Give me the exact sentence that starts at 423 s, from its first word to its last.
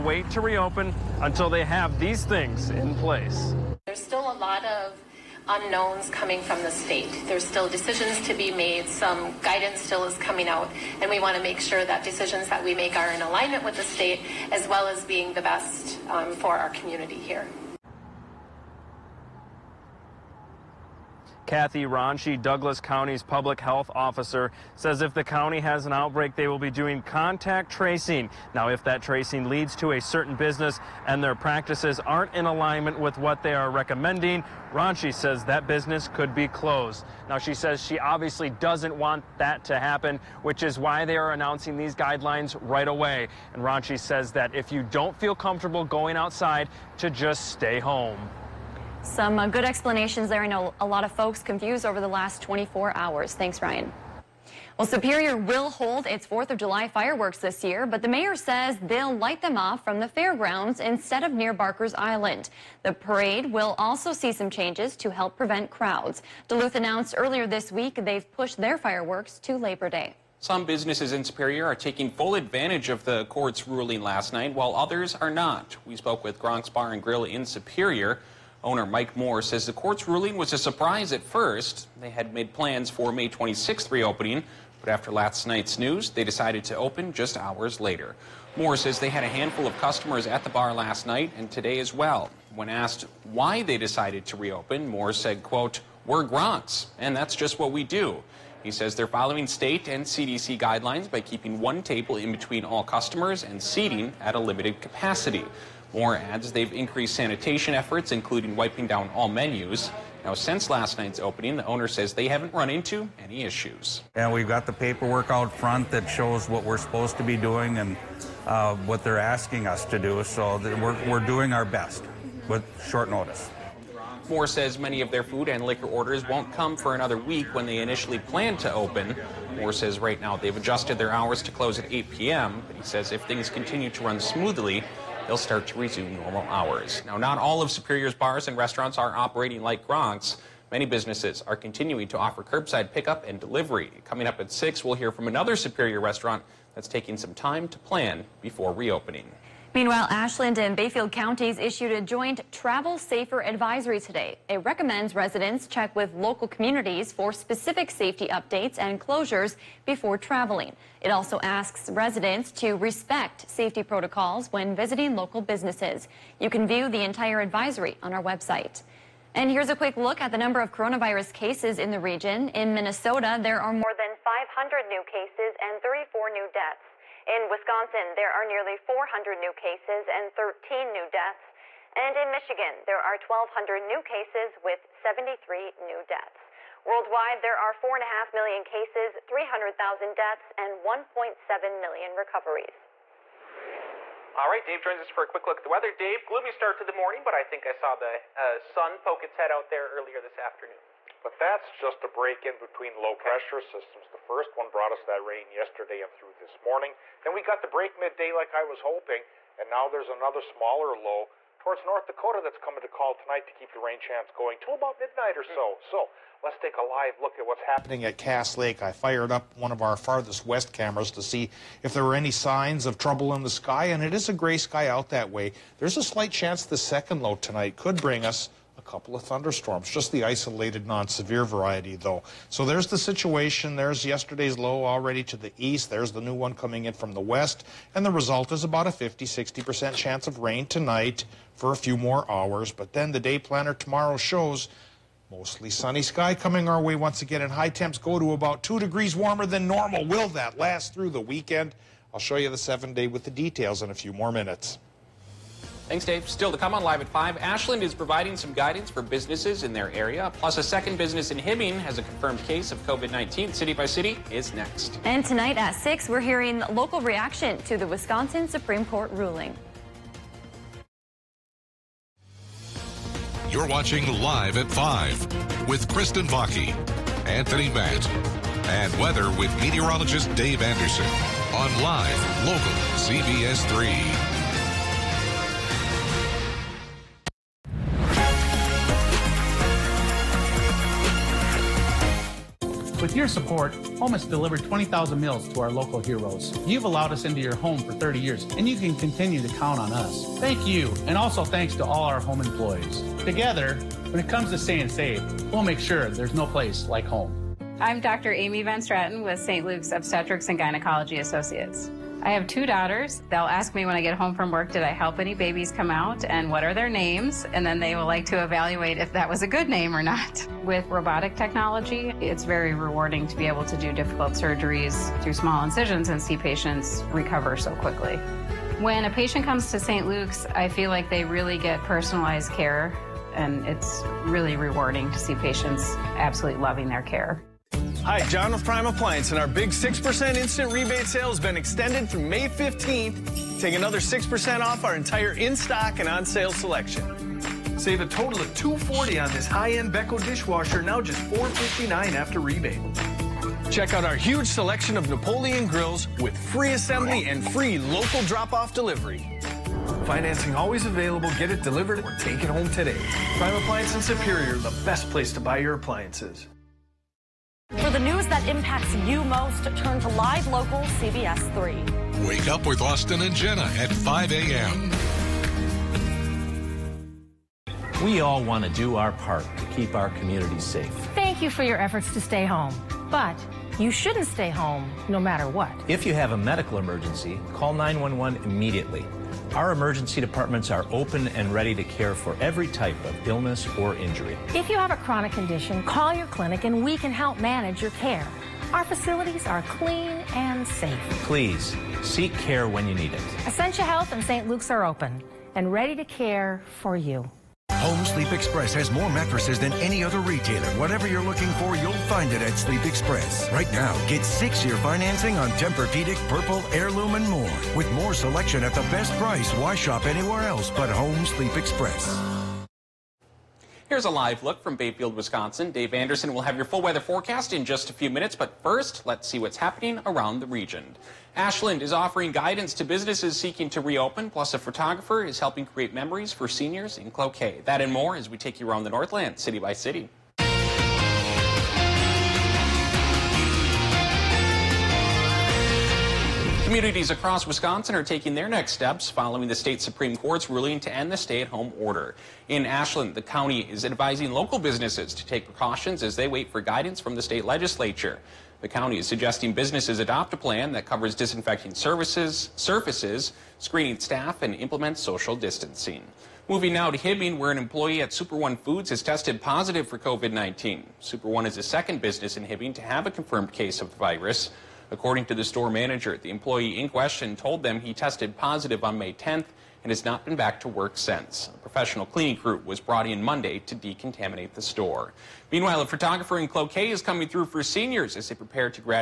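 Here's a live look from Bayfield, Wisconsin.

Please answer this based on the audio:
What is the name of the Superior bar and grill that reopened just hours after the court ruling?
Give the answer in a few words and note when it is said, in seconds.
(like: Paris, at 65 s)
Gronk's Bar and Grill, at 76 s.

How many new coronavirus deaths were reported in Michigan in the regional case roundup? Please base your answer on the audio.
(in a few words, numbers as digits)
73.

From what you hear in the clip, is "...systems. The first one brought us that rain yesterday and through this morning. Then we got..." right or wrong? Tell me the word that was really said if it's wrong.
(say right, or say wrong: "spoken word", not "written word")
right.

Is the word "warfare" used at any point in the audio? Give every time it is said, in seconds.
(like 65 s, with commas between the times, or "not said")
not said.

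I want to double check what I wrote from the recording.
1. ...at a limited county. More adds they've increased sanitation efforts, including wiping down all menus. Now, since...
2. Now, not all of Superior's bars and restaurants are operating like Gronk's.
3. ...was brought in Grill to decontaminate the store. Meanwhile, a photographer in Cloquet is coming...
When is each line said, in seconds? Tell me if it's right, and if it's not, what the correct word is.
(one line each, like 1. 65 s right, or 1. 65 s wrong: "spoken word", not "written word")
1. 104 s wrong: "capacity", not "county"
2. 137 s right
3. 482 s wrong: "Monday", not "Grill".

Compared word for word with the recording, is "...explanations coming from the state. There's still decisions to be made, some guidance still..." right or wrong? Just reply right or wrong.
wrong.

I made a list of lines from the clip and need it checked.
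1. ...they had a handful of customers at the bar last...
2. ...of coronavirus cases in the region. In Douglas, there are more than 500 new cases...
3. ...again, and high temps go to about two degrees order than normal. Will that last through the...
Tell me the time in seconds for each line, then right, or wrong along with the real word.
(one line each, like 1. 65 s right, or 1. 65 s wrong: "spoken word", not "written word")
1. 88 s right
2. 170 s wrong: "Minnesota", not "Douglas"
3. 247 s wrong: "warmer", not "order".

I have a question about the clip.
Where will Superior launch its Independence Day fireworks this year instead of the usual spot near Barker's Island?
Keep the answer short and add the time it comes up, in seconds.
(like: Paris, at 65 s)
the fairgrounds, at 59 s.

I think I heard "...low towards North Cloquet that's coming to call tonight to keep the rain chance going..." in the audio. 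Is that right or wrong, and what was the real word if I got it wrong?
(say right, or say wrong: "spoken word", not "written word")
wrong: "Dakota", not "Cloquet".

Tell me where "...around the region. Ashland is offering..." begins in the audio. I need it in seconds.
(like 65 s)
430 s.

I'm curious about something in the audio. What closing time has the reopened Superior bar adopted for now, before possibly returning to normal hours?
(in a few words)
8 p.m.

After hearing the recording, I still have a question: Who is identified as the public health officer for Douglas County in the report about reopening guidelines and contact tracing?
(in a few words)
Kathy Ronchi.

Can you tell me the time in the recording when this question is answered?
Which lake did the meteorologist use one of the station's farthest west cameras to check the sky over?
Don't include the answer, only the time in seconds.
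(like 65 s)
218 s.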